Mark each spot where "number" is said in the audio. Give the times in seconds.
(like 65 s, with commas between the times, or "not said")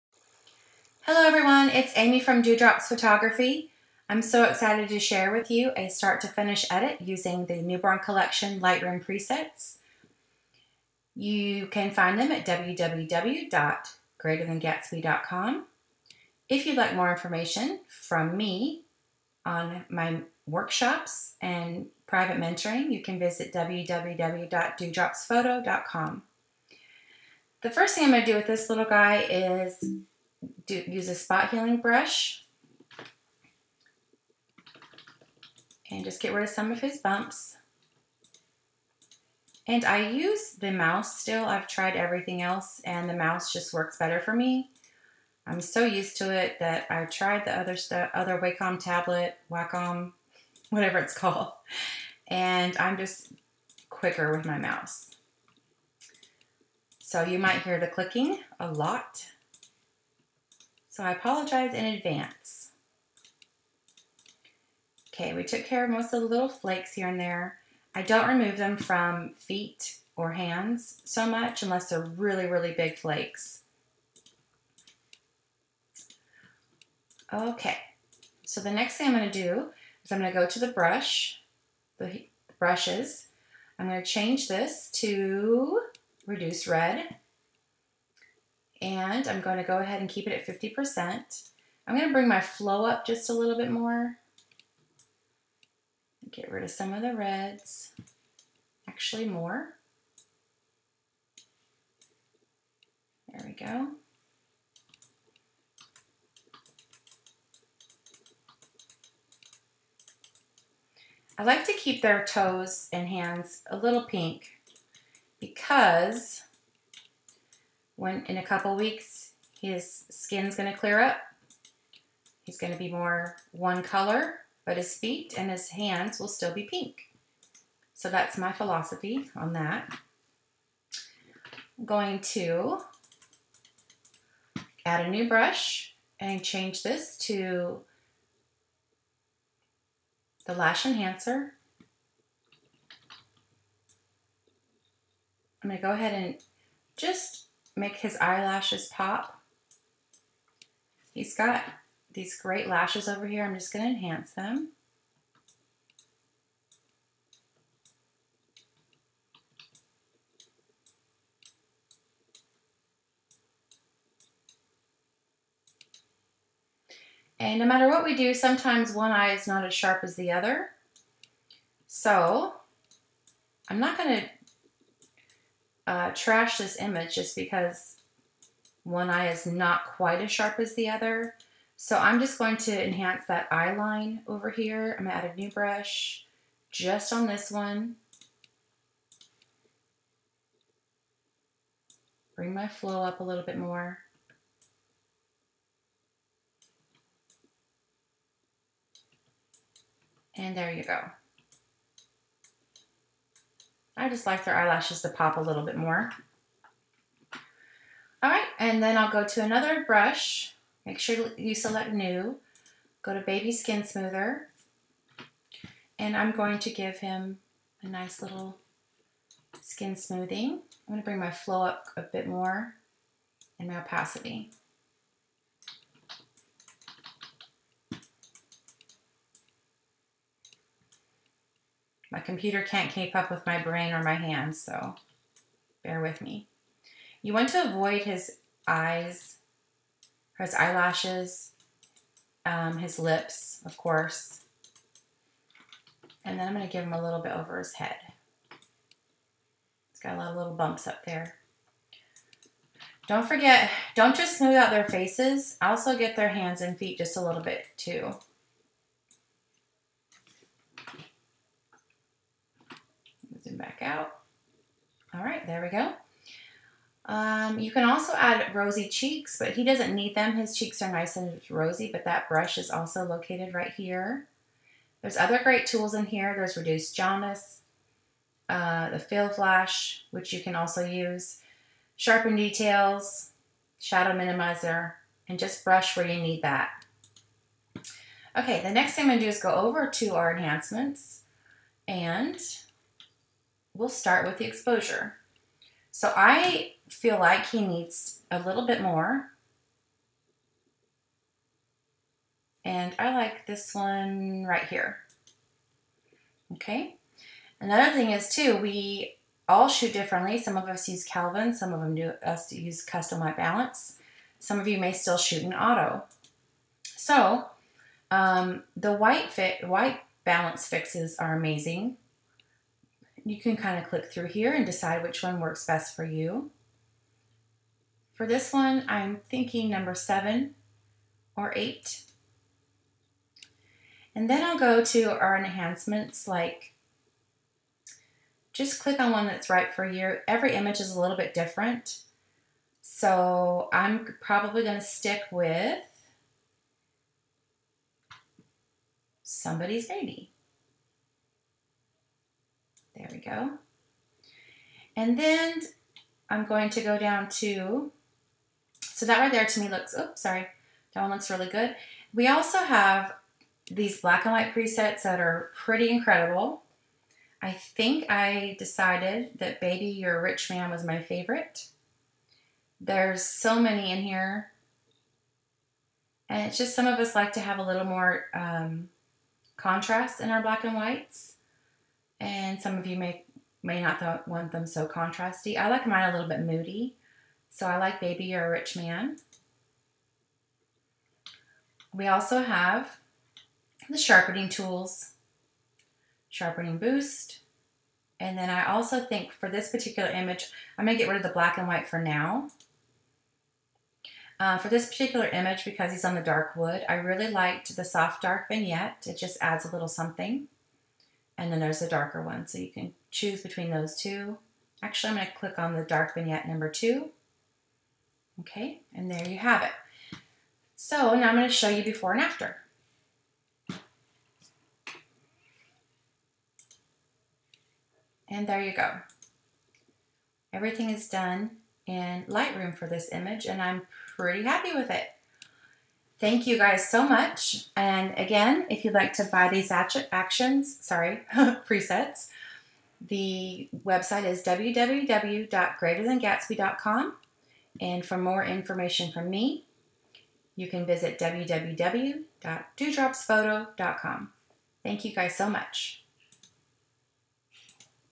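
329 s, 416 s.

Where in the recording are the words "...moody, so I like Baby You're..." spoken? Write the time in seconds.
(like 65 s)
386 s.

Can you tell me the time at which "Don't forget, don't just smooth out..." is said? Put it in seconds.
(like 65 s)
253 s.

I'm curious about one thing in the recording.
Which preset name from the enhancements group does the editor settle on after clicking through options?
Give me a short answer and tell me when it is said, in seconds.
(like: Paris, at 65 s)
Somebody's Baby, at 349 s.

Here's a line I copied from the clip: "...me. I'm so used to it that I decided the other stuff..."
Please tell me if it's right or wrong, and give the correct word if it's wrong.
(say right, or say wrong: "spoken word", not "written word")
wrong: "tried", not "decided".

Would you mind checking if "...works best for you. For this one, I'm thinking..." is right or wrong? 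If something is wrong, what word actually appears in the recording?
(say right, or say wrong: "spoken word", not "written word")
right.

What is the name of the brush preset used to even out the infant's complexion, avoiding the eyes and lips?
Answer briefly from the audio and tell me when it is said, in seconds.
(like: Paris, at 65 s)
Baby Skin Smoother, at 213 s.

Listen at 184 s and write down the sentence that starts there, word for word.
I'm gonna add a new brush just on this one.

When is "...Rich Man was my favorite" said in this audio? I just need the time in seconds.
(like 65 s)
370 s.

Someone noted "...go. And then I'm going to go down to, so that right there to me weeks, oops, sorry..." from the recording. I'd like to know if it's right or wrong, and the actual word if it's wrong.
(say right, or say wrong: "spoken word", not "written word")
wrong: "looks", not "weeks".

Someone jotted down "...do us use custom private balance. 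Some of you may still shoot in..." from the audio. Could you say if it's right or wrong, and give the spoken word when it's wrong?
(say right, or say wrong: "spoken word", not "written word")
wrong: "white", not "private".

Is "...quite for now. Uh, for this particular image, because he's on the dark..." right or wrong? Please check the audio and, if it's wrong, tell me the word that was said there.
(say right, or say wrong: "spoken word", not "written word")
wrong: "white", not "quite".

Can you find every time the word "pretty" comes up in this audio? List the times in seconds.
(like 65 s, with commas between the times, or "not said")
365 s, 434 s.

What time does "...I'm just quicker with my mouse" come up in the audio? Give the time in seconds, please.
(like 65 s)
52 s.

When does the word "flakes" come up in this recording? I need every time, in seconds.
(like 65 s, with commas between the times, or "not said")
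66 s, 72 s.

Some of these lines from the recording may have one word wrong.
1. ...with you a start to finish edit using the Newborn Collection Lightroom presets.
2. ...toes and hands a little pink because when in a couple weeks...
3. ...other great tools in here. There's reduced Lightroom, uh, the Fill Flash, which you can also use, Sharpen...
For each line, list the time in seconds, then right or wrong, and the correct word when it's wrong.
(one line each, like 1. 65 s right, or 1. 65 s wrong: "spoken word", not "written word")
1. 5 s right
2. 112 s right
3. 275 s wrong: "Jaundice", not "Lightroom".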